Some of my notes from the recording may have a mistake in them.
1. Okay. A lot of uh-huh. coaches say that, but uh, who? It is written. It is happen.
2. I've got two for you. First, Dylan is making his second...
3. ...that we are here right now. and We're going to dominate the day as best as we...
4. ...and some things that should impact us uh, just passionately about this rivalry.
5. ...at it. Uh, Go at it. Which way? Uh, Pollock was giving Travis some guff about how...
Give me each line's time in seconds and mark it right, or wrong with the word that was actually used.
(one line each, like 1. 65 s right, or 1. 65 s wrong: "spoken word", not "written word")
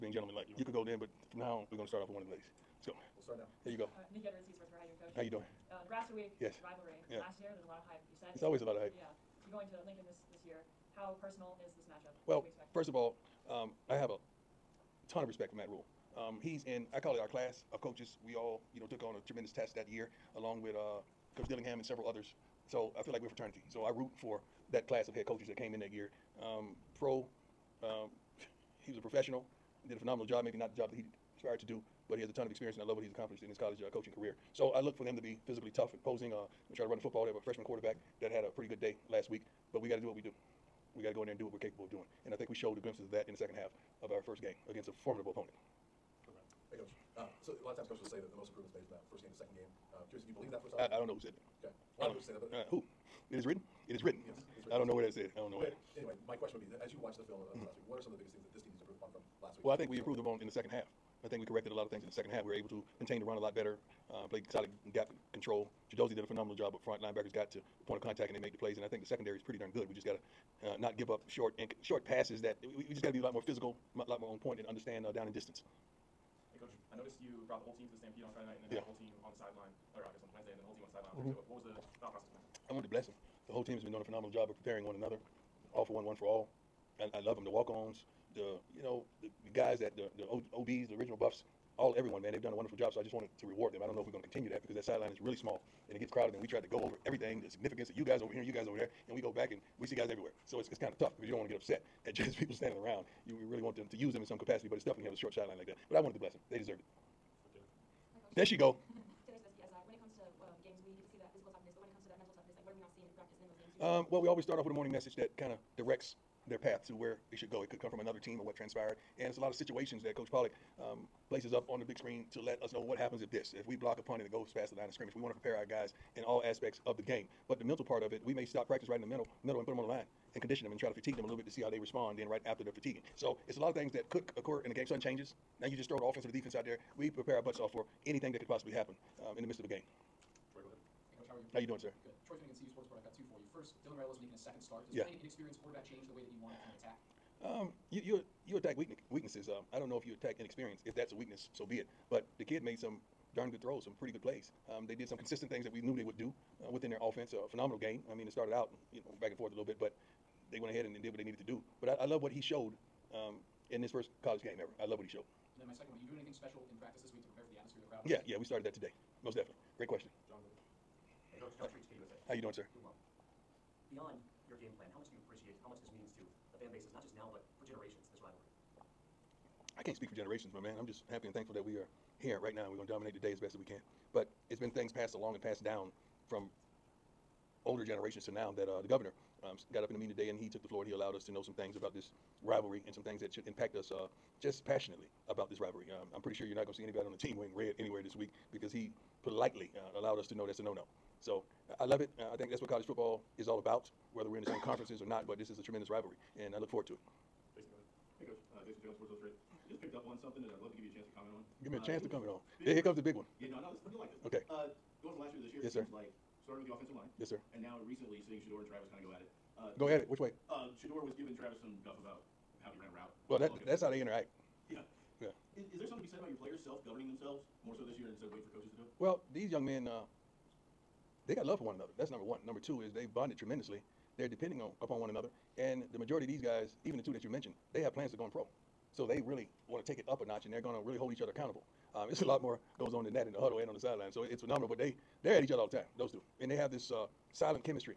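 1. 51 s wrong: "written", not "happen"
2. 142 s right
3. 181 s right
4. 192 s right
5. 219 s wrong: "Shedeur", not "Pollock".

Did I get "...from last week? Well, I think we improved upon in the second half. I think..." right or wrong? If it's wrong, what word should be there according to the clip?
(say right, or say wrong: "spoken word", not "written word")
right.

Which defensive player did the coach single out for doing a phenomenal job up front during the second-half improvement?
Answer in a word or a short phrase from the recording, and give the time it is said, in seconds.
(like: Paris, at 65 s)
Chidozie, at 65 s.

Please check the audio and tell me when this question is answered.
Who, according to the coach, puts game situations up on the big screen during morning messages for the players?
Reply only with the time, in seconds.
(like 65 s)
120 s.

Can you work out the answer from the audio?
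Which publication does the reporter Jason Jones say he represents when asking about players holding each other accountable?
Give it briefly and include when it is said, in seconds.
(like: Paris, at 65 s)
Sports Illustrated, at 208 s.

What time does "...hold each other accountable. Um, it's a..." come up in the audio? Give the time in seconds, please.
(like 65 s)
240 s.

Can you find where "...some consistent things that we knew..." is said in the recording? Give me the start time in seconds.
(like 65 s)
155 s.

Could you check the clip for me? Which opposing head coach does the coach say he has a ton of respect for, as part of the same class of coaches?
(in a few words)
Matt Rhule.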